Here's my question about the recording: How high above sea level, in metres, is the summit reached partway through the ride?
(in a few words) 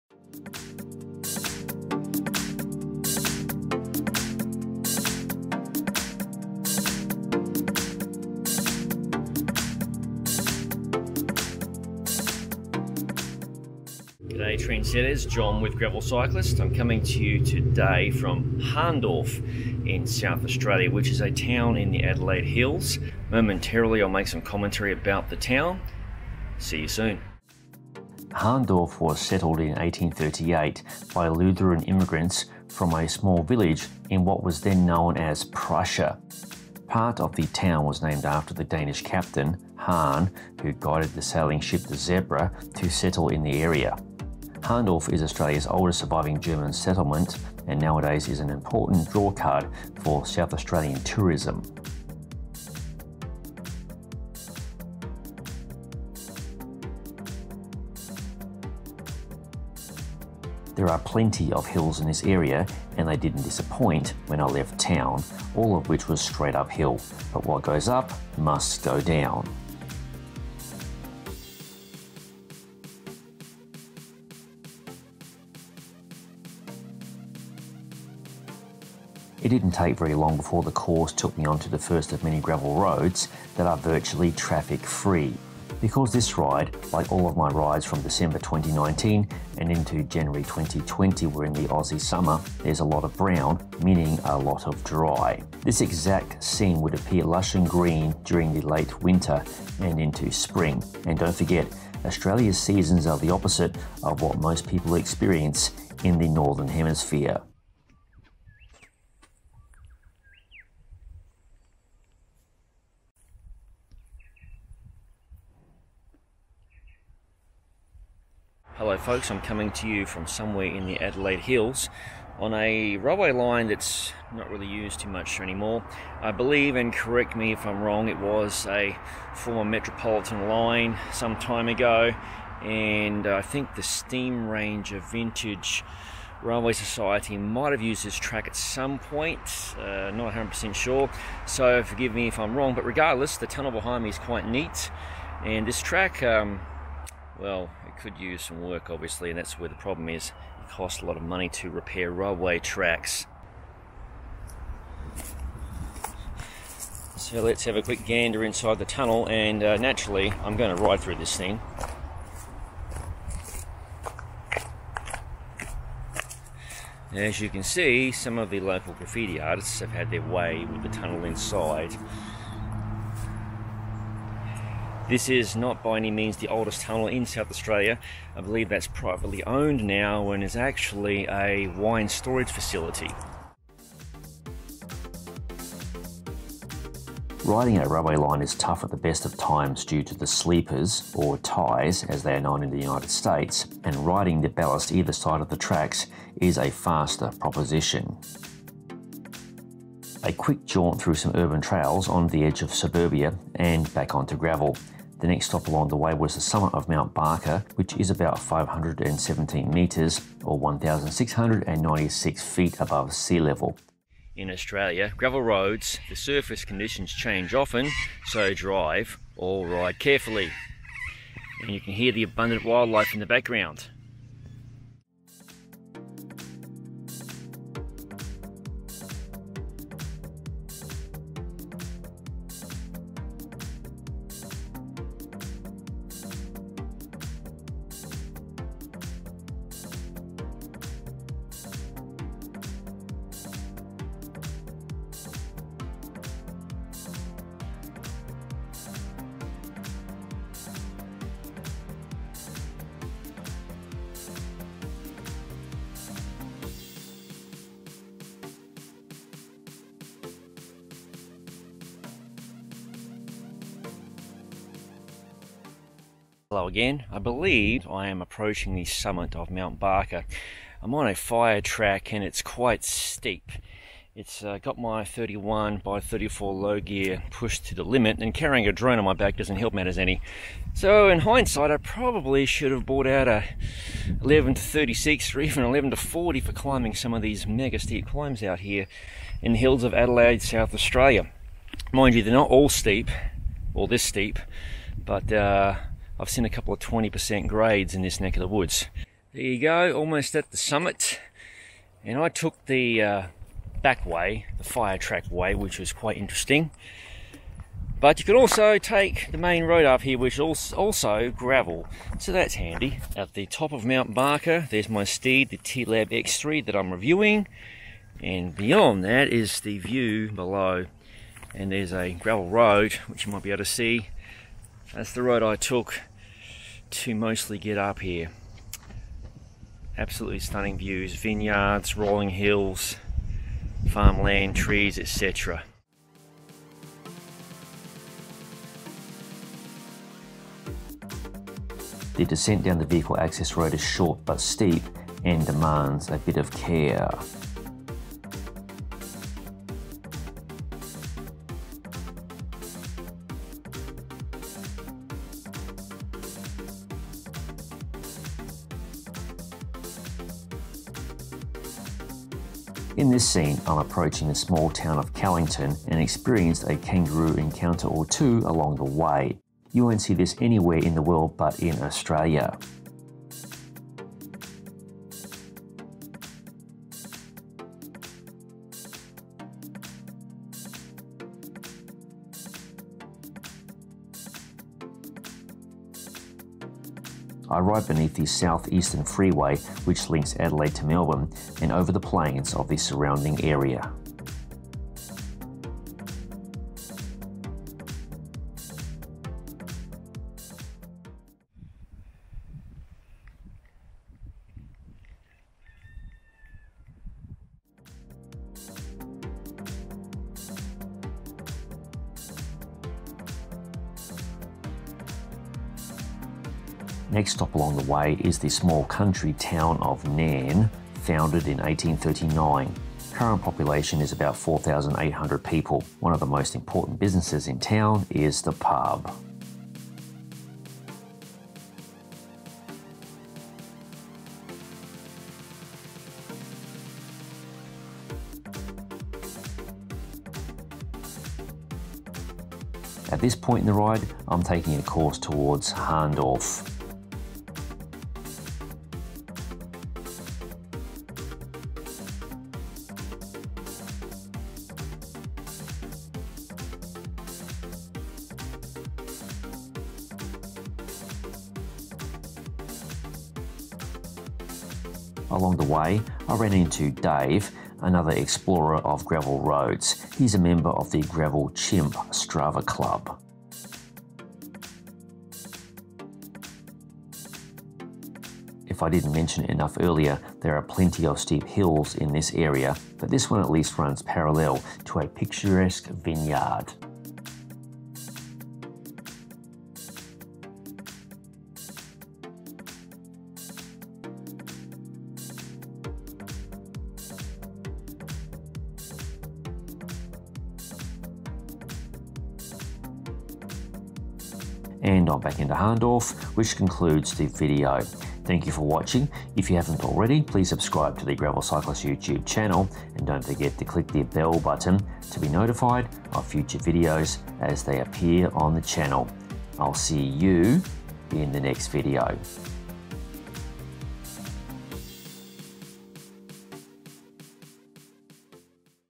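517 metres.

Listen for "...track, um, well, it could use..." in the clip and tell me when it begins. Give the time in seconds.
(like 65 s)
145 s.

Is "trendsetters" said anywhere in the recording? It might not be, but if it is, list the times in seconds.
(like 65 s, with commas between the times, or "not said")
14 s.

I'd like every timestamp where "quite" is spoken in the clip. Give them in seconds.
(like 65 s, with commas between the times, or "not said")
144 s, 272 s, 305 s.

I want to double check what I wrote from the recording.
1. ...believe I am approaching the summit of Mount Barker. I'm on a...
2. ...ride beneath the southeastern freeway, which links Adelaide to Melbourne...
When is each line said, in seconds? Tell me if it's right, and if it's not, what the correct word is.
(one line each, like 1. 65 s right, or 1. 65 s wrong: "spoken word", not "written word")
1. 267 s right
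2. 387 s right.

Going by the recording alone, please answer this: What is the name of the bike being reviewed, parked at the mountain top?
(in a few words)
T-Lab X3.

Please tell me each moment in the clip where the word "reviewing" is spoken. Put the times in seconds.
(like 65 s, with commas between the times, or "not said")
316 s.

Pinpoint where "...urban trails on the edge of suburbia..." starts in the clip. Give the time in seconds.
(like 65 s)
201 s.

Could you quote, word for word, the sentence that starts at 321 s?
And there's a gravel road, which you might be able to see.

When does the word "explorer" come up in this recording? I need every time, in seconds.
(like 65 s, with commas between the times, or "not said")
468 s.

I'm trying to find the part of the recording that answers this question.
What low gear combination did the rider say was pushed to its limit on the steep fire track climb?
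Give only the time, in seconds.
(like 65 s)
275 s.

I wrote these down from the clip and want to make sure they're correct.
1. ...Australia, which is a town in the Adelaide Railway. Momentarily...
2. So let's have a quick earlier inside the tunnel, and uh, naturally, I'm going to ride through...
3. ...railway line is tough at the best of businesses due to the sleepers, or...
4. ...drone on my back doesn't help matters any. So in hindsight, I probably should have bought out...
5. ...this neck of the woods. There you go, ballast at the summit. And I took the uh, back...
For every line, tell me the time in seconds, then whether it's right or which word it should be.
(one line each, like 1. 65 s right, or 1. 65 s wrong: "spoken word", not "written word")
1. 20 s wrong: "Hills", not "Railway"
2. 157 s wrong: "gander", not "earlier"
3. 187 s wrong: "times", not "businesses"
4. 278 s right
5. 298 s wrong: "almost", not "ballast".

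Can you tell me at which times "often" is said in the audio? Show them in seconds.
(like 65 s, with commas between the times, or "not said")
217 s.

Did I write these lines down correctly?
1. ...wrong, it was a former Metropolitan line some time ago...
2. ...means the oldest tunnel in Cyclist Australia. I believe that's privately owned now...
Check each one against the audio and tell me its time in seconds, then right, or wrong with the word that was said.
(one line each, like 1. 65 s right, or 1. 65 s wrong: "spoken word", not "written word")
1. 127 s right
2. 176 s wrong: "South", not "Cyclist".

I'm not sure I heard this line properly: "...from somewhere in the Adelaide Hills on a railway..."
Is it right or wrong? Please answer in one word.
right.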